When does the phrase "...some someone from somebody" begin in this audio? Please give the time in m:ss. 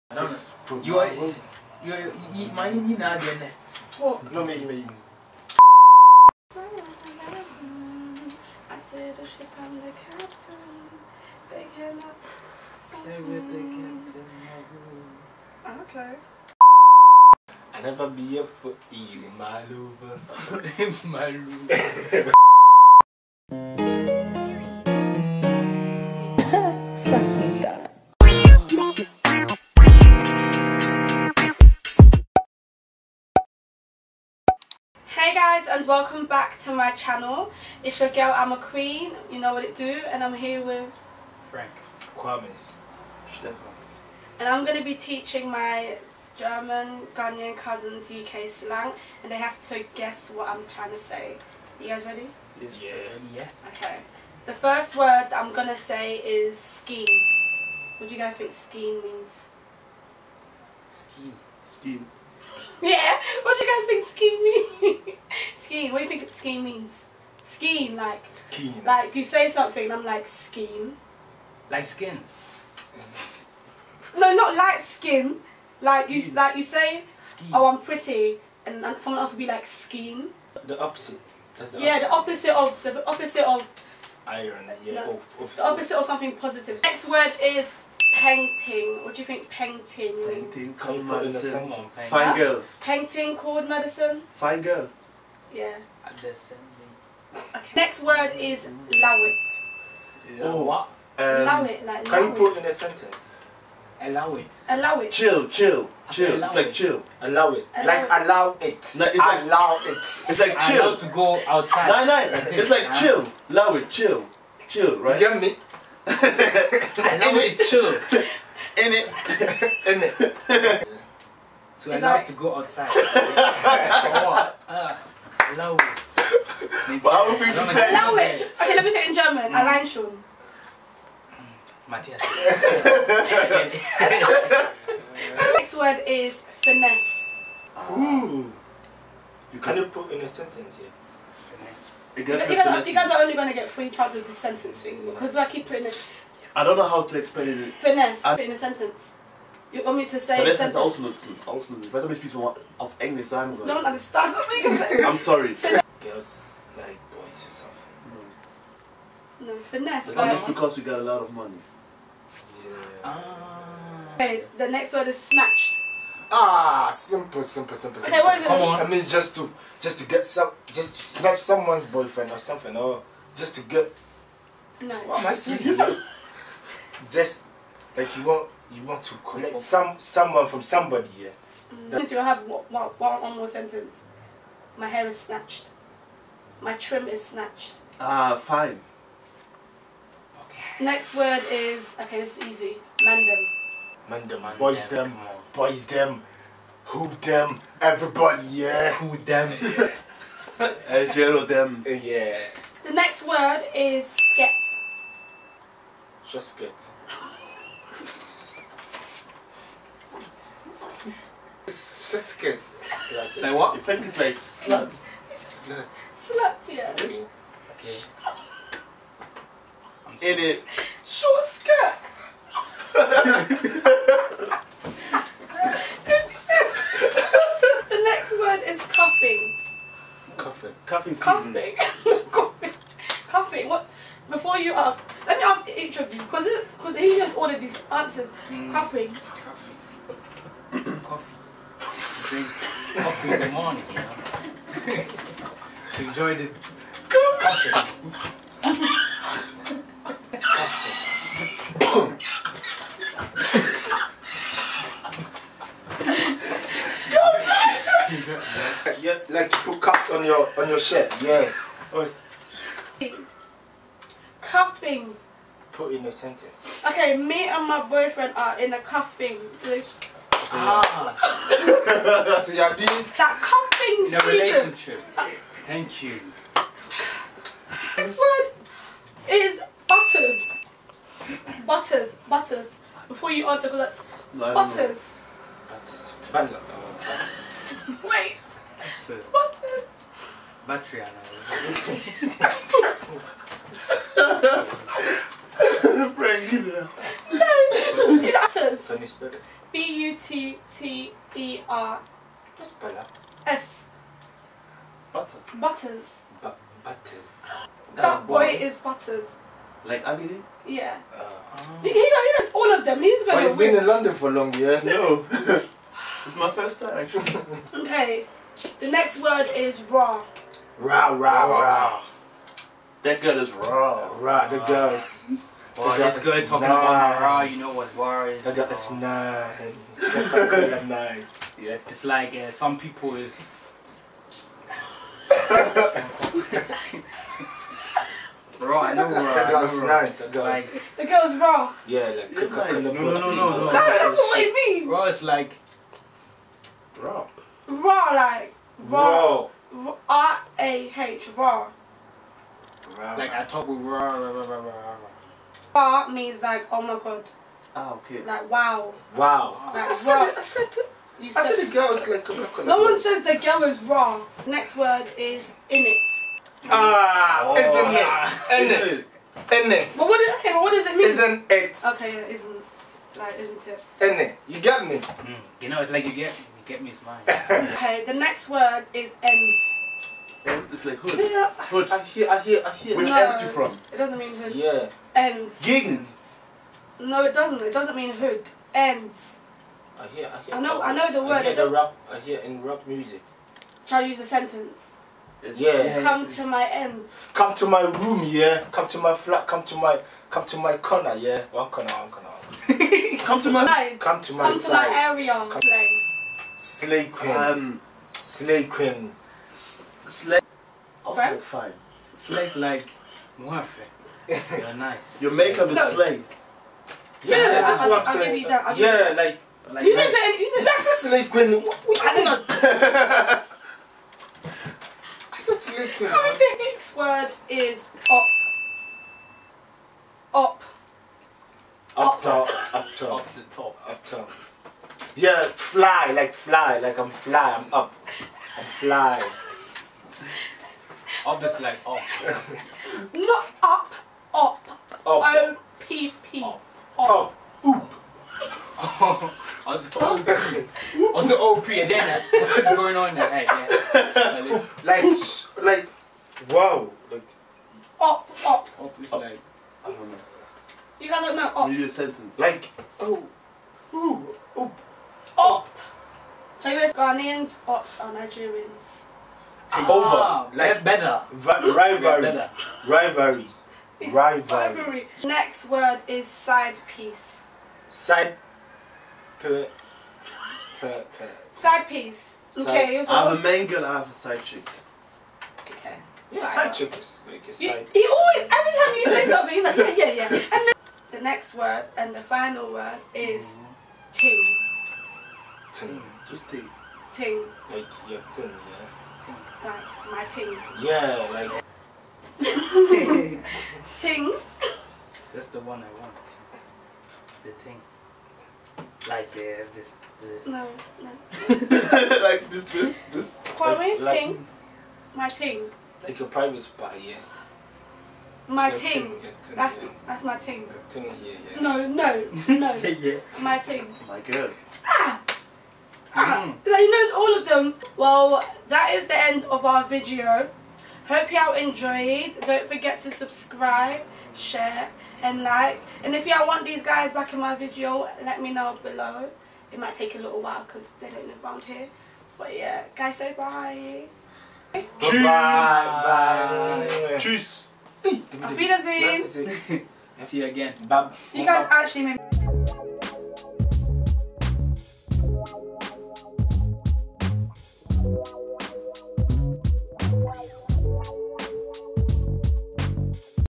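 2:59.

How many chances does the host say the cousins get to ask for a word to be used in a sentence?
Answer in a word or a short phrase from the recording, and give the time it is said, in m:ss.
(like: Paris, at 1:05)
3, at 2:23.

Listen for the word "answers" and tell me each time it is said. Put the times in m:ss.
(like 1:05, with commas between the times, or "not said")
3:57, 4:43.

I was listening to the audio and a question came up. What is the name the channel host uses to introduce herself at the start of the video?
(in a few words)
Ama Queen.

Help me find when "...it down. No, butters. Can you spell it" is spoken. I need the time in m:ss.
4:56.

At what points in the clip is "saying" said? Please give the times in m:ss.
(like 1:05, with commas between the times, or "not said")
2:34, 2:55, 6:58.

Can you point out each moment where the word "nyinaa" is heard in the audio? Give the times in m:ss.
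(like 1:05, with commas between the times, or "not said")
0:01.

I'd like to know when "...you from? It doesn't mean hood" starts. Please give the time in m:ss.
6:23.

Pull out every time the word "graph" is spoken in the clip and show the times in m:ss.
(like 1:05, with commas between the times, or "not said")
not said.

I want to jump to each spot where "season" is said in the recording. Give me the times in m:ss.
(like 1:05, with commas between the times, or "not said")
3:51, 4:34.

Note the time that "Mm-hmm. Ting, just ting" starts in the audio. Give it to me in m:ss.
8:14.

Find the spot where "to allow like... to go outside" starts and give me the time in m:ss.
2:01.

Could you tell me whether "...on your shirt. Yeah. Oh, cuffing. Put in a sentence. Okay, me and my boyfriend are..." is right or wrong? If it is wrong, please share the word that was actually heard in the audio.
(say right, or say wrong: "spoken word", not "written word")
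right.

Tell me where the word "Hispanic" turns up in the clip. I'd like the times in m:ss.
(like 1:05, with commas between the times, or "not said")
not said.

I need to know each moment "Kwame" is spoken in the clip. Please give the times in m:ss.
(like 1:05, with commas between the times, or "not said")
0:42, 8:33.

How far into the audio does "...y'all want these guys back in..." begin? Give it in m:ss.
8:56.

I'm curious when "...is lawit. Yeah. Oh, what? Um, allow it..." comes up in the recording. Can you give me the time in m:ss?
1:38.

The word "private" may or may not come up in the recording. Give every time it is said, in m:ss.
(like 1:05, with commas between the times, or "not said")
8:36.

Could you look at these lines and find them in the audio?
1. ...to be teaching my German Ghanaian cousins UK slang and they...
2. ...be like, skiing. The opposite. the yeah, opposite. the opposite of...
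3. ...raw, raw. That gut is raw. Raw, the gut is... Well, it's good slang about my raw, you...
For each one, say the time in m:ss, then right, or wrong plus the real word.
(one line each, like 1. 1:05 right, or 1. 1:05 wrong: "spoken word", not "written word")
1. 0:44 right
2. 1:19 right
3. 5:21 wrong: "talking", not "slang".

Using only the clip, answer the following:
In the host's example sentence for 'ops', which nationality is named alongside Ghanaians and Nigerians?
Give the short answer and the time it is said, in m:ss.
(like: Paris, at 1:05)
Chinese, at 7:46.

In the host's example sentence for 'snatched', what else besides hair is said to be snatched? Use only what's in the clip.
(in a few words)
My trim.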